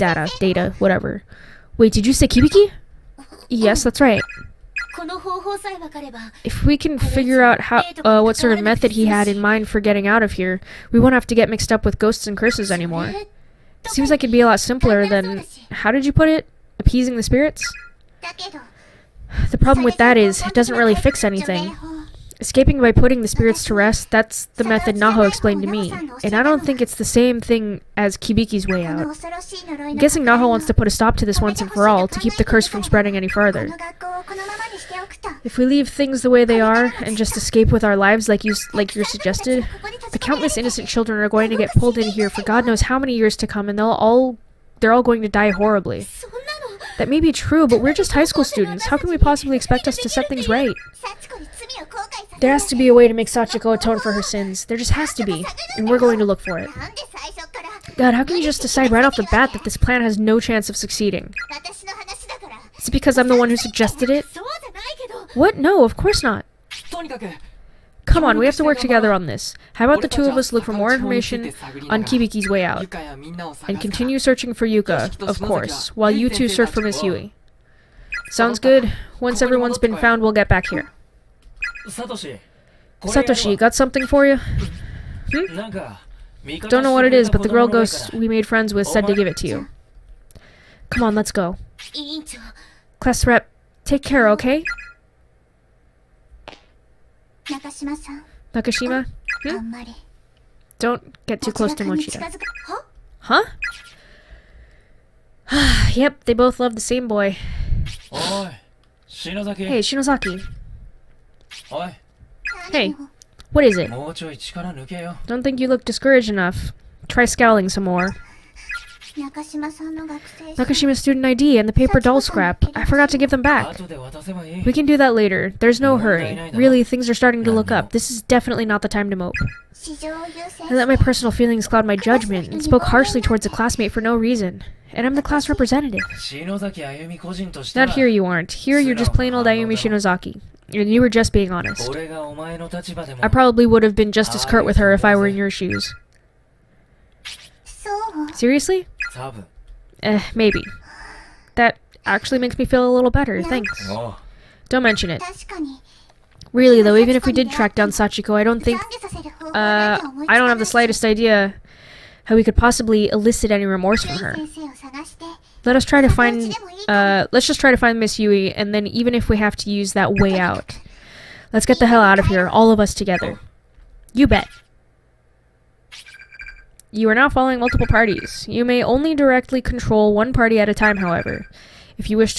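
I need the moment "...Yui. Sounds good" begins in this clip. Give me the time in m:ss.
1:17.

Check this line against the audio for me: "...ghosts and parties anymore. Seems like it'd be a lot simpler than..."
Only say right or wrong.
wrong.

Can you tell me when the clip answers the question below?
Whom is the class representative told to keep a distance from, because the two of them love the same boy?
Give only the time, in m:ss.
1:41.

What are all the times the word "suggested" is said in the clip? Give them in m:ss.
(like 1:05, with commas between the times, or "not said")
0:39, 1:03.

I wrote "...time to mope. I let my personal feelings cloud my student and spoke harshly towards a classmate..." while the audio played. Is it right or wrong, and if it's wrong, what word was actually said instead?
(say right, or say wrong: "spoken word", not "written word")
wrong: "judgment", not "student".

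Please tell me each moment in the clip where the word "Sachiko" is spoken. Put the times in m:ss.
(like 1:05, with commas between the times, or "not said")
0:53, 2:37.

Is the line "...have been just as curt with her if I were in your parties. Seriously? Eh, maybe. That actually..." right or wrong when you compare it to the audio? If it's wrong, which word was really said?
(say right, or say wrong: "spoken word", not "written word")
wrong: "shoes", not "parties".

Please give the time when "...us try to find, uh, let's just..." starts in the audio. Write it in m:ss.
2:45.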